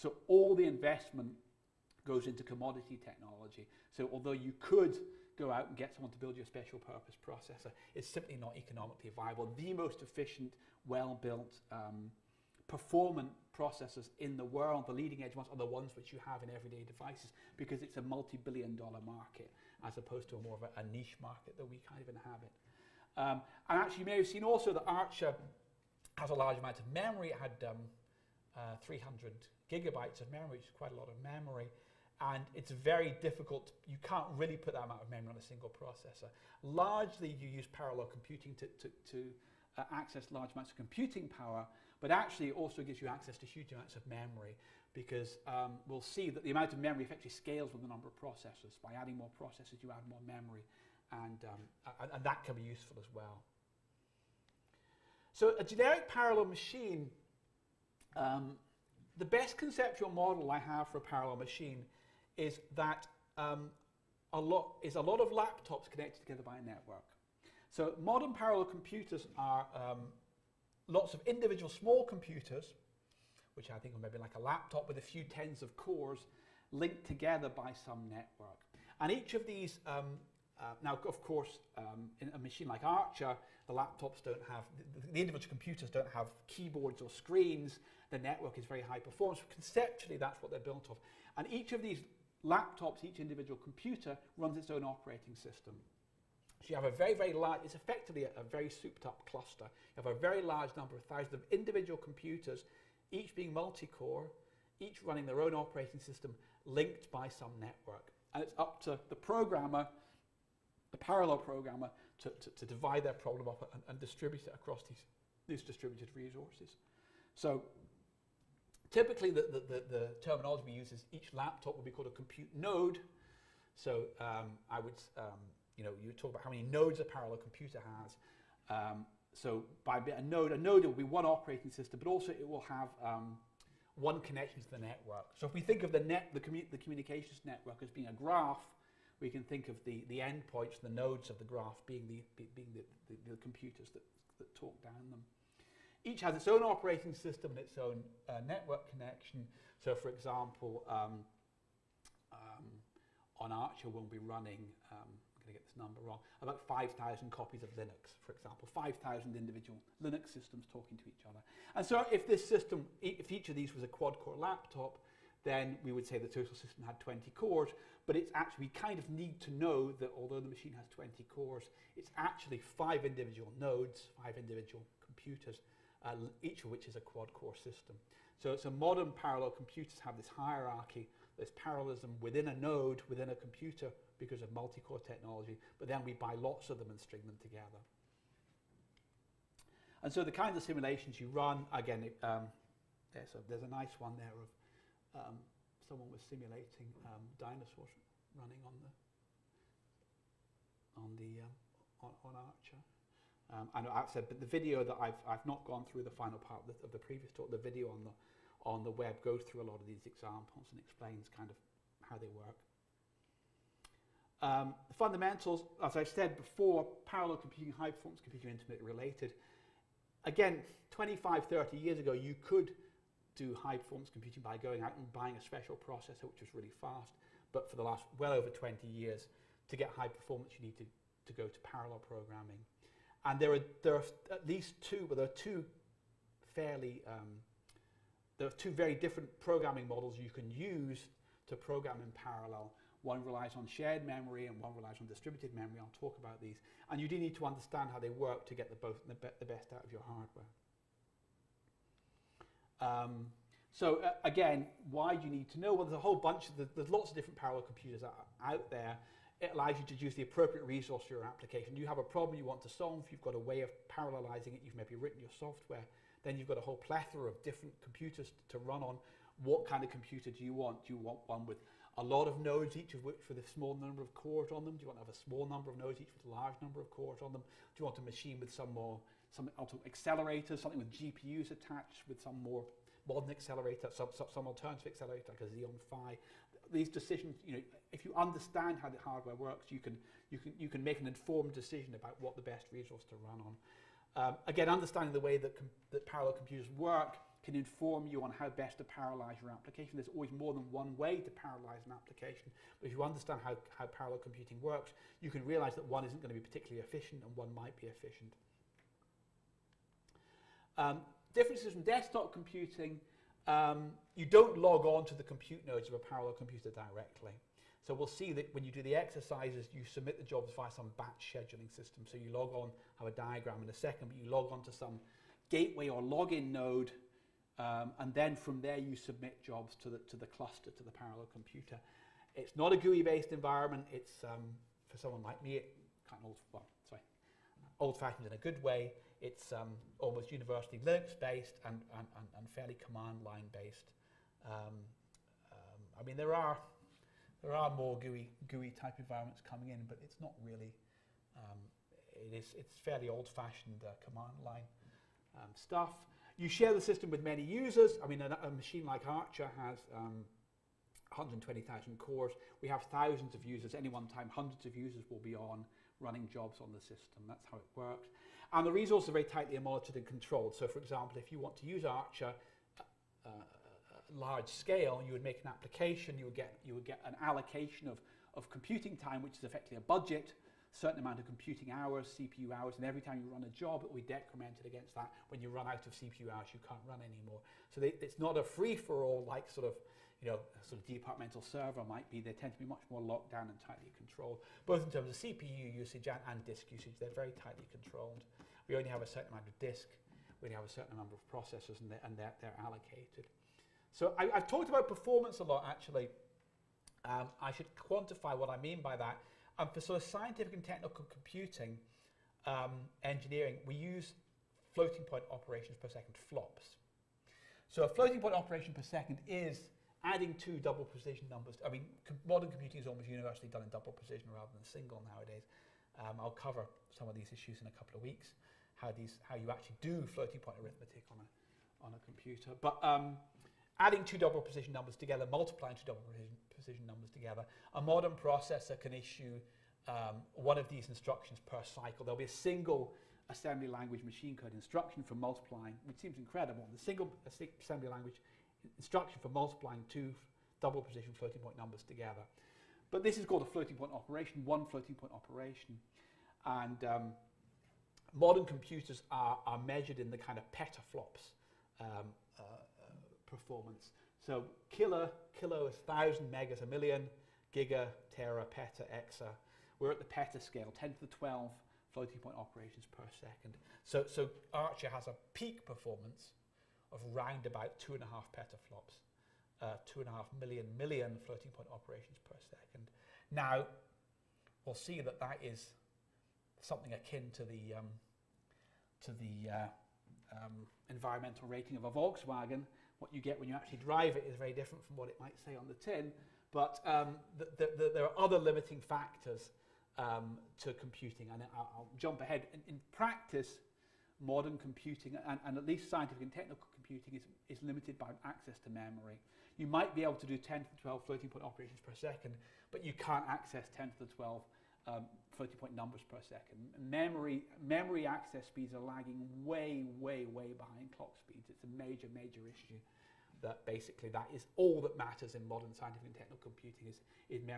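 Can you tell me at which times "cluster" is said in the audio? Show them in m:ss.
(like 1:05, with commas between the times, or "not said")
1:39, 5:30.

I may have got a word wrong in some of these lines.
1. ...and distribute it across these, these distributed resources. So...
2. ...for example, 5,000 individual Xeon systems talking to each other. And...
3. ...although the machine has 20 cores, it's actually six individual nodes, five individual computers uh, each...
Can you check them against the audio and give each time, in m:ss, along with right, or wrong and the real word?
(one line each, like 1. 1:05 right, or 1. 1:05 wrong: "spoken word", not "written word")
1. 1:53 right
2. 2:38 wrong: "Linux", not "Xeon"
3. 2:50 wrong: "five", not "six".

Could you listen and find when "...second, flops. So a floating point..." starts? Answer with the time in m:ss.
6:55.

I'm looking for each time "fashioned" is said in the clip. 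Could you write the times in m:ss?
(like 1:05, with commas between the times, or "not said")
5:37, 5:53.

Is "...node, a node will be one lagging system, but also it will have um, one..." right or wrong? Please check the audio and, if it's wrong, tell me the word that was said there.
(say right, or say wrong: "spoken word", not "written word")
wrong: "operating", not "lagging".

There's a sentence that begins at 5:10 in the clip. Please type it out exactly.
Um, differences from desktop computing, um, you don't log on to the compute nodes of a parallel computer directly.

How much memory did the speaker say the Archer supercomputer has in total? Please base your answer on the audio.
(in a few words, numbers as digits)
300 gigabytes.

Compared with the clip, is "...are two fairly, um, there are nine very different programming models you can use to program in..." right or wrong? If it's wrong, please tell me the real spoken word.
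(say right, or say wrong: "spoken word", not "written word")
wrong: "two", not "nine".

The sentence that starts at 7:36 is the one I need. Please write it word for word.
And um, modern computers are, are measured in the kind of petaflops um, performance.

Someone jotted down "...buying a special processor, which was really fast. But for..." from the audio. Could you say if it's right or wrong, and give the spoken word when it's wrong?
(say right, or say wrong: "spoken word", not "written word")
right.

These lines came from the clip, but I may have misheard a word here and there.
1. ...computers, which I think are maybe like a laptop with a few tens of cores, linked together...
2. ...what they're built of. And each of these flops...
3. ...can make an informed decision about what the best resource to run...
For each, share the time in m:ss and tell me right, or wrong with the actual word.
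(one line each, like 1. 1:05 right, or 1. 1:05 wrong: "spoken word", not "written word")
1. 1:12 right
2. 1:30 wrong: "laptops", not "flops"
3. 4:50 right.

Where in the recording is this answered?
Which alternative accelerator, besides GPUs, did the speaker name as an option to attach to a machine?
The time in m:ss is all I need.
4:45.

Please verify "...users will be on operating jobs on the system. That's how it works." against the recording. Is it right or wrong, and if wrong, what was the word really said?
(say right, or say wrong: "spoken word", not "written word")
wrong: "running", not "operating".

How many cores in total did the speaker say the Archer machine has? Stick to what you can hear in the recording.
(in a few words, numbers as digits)
120,000.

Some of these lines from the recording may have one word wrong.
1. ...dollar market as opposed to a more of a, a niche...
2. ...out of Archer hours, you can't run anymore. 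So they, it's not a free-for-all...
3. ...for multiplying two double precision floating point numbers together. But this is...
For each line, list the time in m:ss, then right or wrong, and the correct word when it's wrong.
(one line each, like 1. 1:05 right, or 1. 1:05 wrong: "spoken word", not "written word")
1. 0:18 right
2. 6:25 wrong: "CPU", not "Archer"
3. 7:29 right.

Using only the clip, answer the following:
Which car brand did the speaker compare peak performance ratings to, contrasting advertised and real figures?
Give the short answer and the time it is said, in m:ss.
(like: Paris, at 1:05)
Volkswagen, at 8:11.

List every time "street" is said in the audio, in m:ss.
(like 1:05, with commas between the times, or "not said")
not said.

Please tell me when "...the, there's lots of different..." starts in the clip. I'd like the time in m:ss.
4:16.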